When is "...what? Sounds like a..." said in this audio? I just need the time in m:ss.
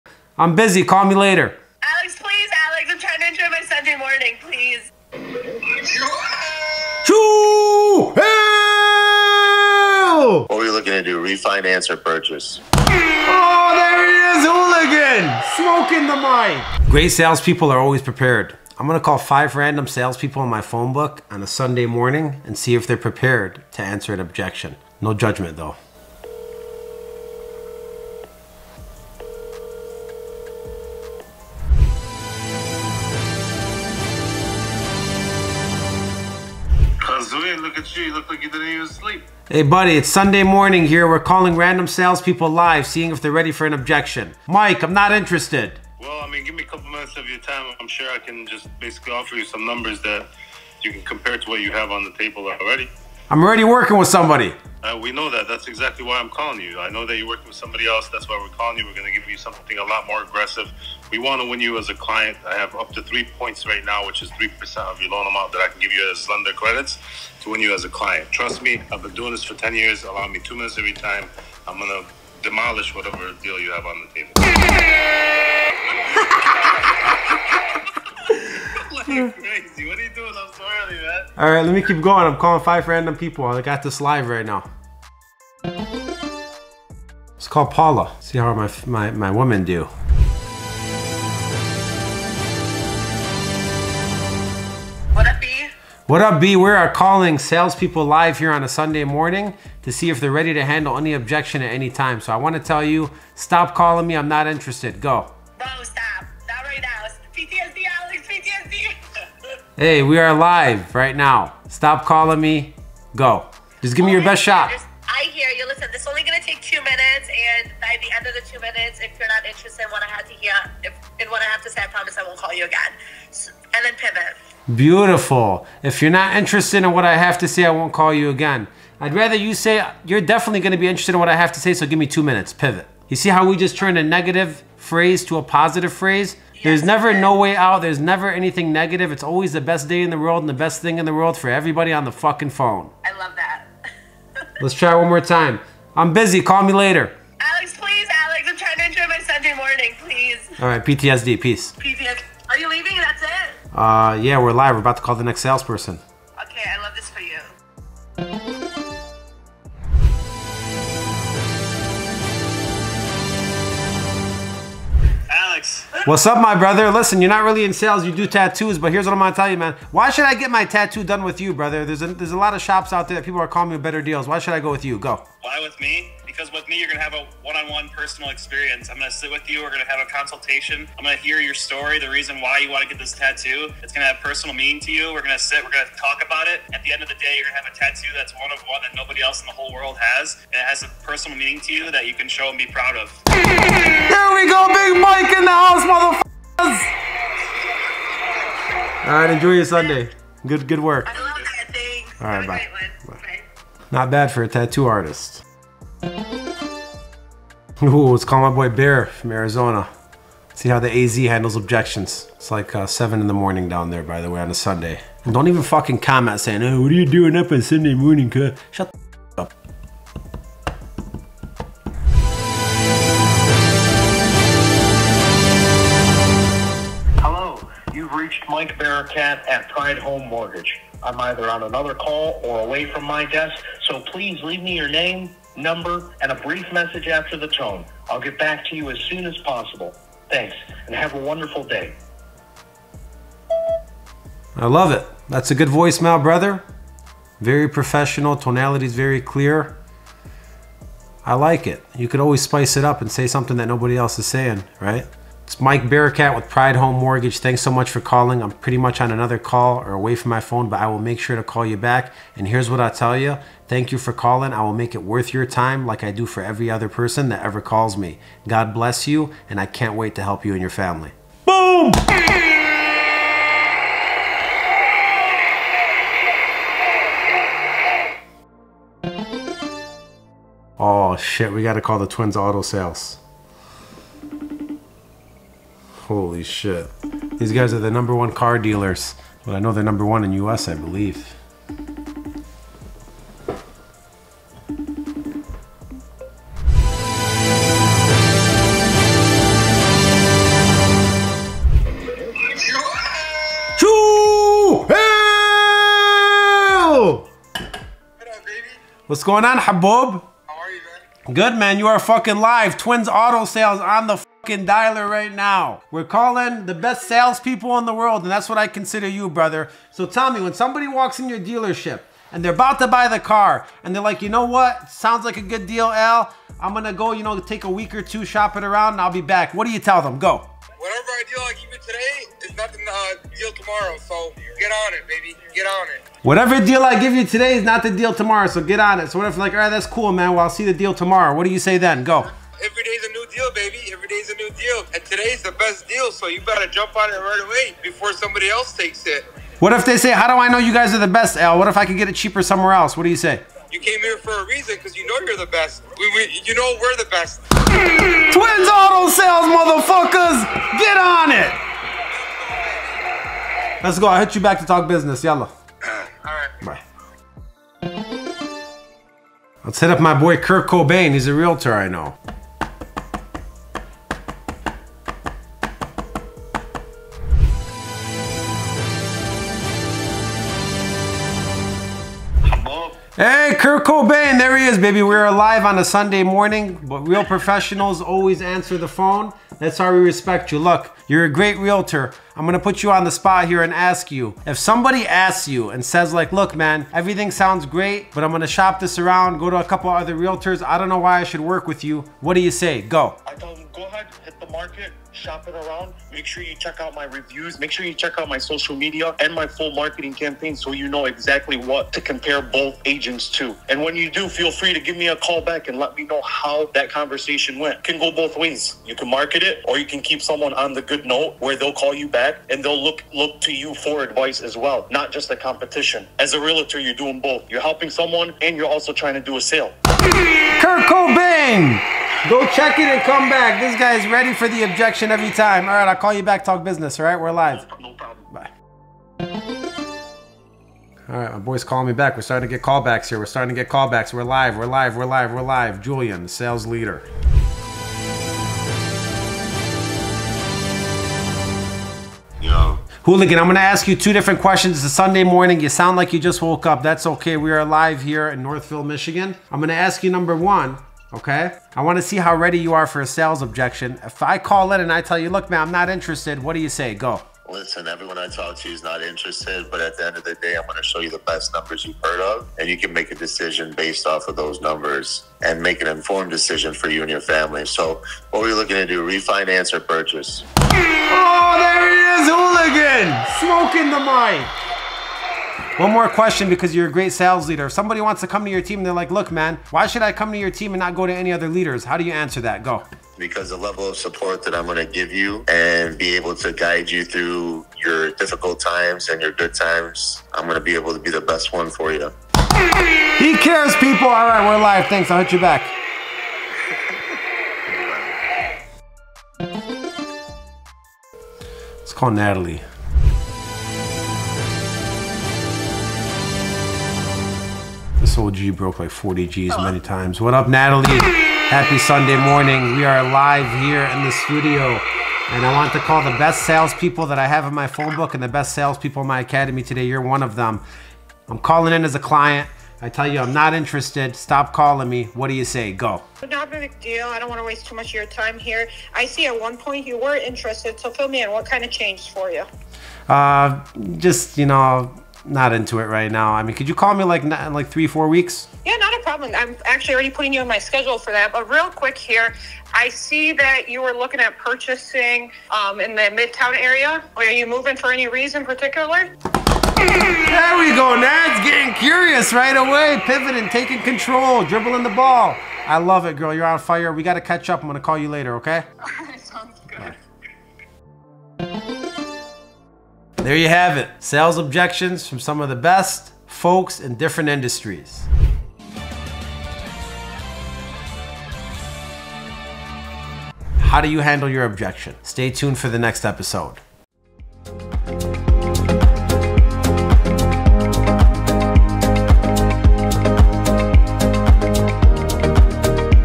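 5:24.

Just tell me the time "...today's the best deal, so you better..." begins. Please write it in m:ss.
5:45.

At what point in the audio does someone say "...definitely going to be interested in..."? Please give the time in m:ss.
2:10.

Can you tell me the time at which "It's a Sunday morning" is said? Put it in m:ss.
7:34.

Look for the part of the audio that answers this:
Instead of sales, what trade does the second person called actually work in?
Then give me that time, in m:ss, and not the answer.
2:48.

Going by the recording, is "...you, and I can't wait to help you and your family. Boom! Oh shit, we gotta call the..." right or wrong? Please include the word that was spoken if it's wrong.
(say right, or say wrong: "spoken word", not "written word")
right.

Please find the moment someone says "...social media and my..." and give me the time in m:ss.
6:48.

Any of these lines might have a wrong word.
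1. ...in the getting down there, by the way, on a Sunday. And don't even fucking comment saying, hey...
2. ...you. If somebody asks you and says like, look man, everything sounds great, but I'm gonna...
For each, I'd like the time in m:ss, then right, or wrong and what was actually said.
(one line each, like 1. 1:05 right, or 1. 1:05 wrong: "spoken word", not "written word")
1. 3:33 wrong: "morning", not "getting"
2. 6:34 right.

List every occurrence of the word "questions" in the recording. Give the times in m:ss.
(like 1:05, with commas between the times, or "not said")
7:34, 8:06.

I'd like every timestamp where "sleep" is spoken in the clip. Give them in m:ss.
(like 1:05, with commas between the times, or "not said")
0:38.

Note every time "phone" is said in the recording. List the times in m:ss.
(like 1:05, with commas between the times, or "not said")
0:20, 2:22, 4:20, 6:28, 8:47.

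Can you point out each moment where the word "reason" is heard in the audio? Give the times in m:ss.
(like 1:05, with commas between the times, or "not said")
3:02, 5:54, 9:18.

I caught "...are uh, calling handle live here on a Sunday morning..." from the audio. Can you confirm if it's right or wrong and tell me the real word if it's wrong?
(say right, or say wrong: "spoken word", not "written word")
wrong: "salespeople", not "handle".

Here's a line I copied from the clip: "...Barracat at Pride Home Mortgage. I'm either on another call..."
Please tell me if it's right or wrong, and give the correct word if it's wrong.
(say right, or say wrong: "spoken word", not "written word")
right.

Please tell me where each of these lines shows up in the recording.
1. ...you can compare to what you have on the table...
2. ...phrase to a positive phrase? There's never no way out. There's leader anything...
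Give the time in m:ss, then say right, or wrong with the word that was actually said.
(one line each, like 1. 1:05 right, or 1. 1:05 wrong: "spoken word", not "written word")
1. 0:50 right
2. 2:14 wrong: "never", not "leader".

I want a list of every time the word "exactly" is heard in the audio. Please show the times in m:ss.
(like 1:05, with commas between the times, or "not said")
0:55, 6:51.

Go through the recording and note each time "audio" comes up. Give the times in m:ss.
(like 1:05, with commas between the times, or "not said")
not said.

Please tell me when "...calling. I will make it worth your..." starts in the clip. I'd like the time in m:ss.
4:24.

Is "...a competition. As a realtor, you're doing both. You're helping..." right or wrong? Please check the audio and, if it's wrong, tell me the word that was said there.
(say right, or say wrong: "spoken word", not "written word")
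right.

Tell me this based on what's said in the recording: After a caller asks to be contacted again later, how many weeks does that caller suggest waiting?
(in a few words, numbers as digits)
3-4 weeks.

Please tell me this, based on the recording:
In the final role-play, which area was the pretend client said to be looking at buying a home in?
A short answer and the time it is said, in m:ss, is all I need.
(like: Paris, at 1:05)
Midtown, at 9:16.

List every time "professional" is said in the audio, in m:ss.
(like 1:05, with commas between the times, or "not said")
4:07, 6:27.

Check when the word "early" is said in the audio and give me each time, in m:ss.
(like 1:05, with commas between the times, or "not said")
1:20.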